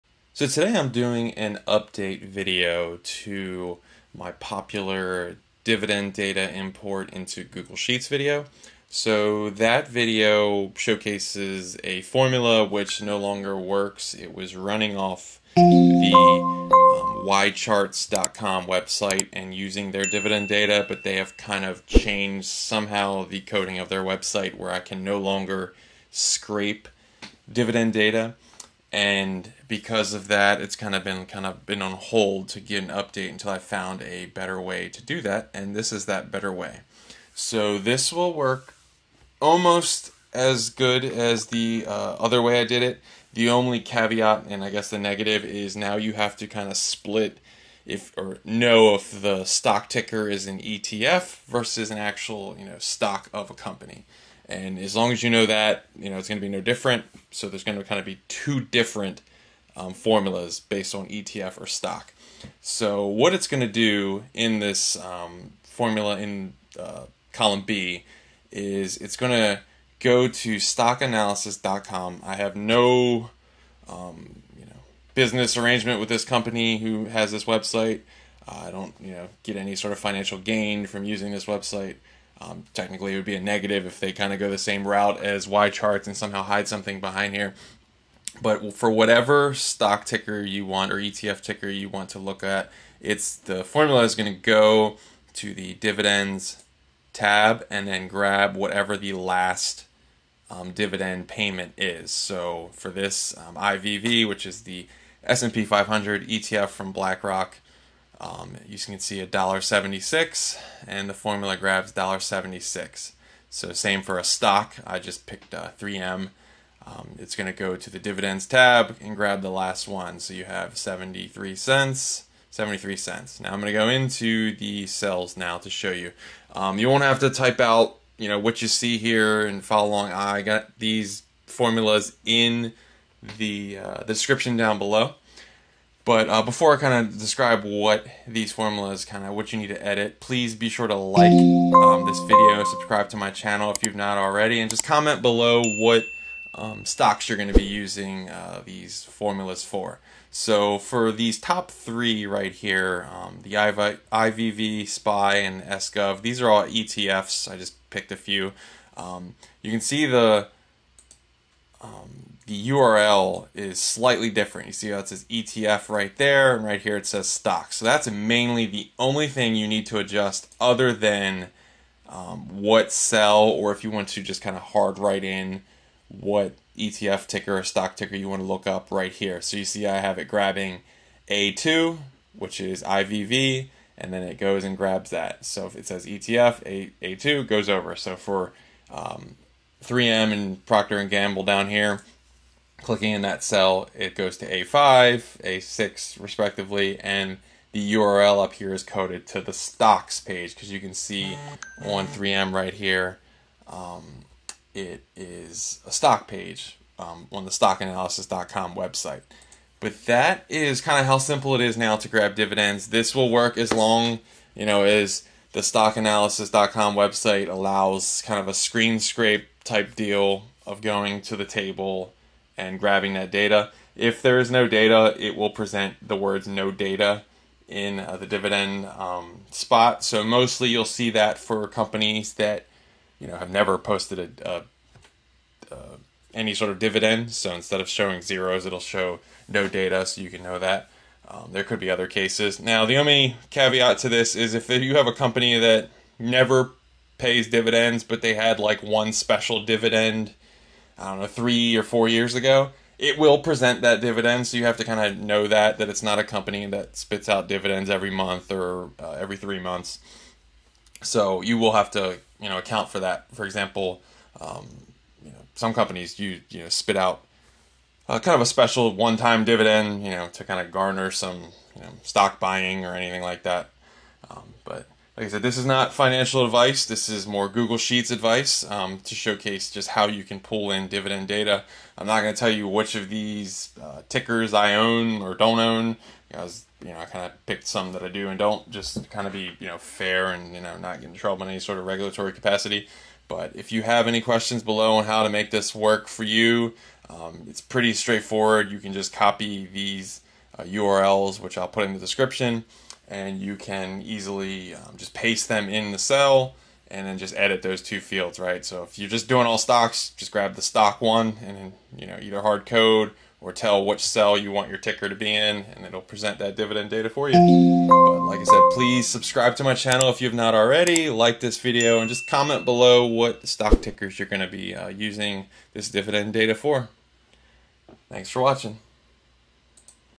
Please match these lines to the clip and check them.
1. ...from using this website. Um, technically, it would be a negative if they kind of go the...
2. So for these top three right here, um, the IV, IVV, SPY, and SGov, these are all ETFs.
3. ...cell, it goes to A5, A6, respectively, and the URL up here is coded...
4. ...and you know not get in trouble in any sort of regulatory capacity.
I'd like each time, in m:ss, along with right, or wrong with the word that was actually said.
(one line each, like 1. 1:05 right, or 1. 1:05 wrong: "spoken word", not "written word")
1. 1:20 right
2. 2:30 right
3. 3:13 right
4. 4:50 right.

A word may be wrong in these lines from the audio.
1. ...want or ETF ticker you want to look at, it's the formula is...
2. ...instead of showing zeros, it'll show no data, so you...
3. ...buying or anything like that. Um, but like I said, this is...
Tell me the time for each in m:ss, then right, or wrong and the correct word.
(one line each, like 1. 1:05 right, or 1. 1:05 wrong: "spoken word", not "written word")
1. 1:30 right
2. 3:57 right
3. 4:32 right.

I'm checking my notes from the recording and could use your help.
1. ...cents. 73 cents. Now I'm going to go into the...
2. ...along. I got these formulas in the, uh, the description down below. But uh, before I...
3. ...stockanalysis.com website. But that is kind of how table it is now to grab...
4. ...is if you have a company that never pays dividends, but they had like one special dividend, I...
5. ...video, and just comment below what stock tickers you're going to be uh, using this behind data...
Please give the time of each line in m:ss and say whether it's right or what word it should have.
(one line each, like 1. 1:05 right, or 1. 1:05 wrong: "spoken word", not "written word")
1. 2:01 right
2. 2:09 right
3. 3:27 wrong: "simple", not "table"
4. 4:04 right
5. 5:21 wrong: "dividend", not "behind".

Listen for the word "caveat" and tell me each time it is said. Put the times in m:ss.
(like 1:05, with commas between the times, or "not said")
0:43, 4:03.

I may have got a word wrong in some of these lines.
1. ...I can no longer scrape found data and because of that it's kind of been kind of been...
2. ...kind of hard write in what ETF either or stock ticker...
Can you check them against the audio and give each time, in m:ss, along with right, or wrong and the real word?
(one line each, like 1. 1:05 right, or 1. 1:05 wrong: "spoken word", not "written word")
1. 0:24 wrong: "dividend", not "found"
2. 2:54 wrong: "ticker", not "either".